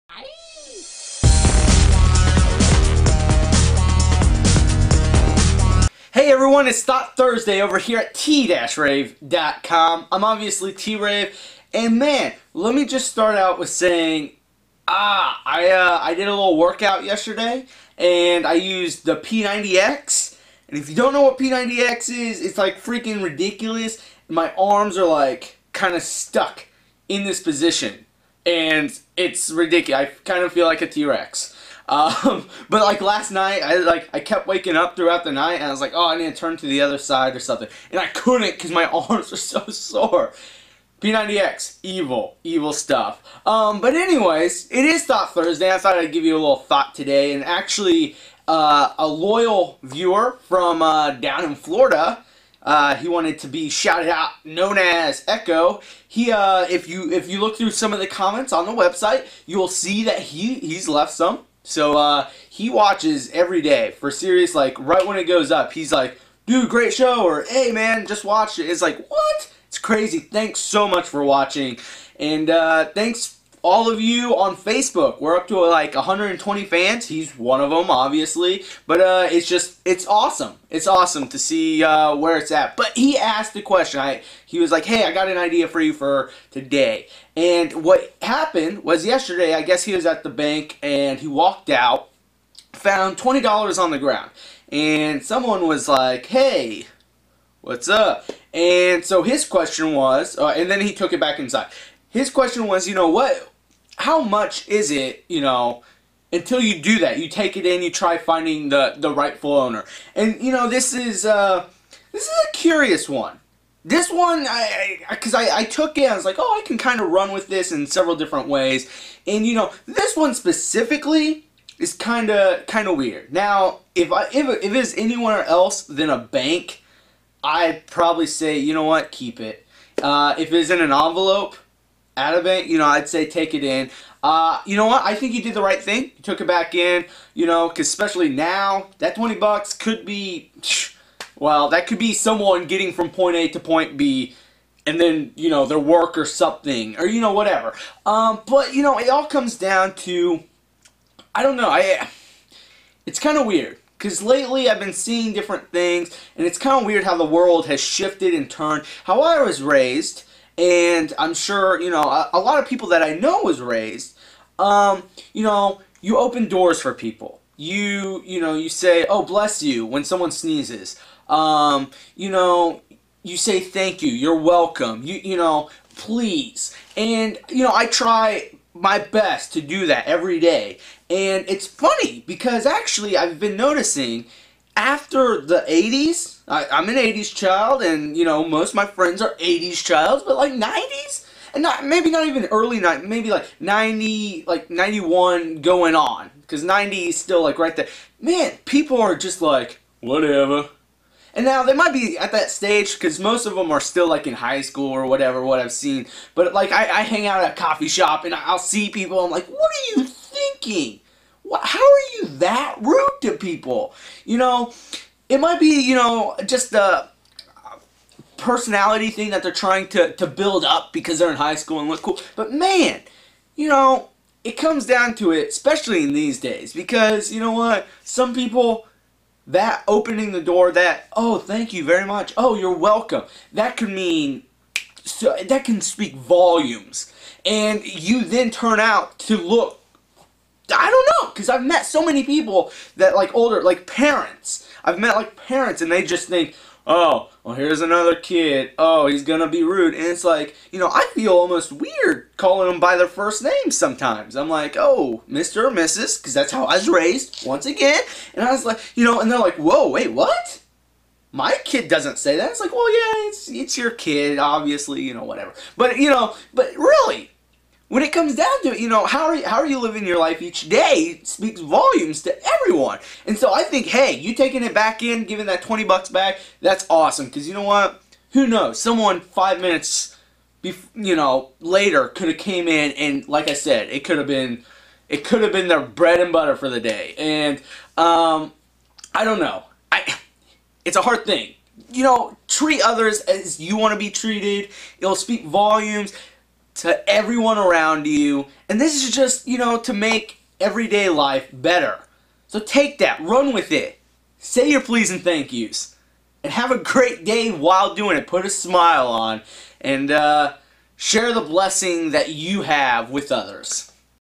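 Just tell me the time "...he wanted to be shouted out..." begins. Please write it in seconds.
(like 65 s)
52 s.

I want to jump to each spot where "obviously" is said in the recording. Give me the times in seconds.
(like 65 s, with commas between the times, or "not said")
10 s, 77 s, 264 s.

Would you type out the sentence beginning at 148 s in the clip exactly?
Um, but, you know, it all comes down to, I don't know, I, it's kind of weird.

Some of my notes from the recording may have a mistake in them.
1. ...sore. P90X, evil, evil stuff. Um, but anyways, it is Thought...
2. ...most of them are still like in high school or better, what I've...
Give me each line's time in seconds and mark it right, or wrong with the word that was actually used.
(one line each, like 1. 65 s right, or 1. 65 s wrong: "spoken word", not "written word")
1. 39 s right
2. 203 s wrong: "whatever", not "better".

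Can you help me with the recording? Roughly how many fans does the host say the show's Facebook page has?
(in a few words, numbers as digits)
120.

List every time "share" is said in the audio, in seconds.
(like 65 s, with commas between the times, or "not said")
310 s.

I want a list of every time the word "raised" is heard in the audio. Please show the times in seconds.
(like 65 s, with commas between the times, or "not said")
159 s, 163 s, 256 s.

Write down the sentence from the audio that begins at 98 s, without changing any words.
And so his question was, uh, and then he took it back inside.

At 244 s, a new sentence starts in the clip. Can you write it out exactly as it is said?
I've met like parents, and they just think, oh, well, here's another kid.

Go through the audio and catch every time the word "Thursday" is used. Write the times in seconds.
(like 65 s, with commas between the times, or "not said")
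7 s, 45 s.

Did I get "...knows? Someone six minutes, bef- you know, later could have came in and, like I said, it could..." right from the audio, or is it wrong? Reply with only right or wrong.
wrong.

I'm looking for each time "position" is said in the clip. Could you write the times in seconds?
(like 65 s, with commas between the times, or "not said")
27 s.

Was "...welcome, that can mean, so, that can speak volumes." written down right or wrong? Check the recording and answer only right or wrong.
right.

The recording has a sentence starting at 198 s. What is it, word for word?
Man, people are just like, whatever.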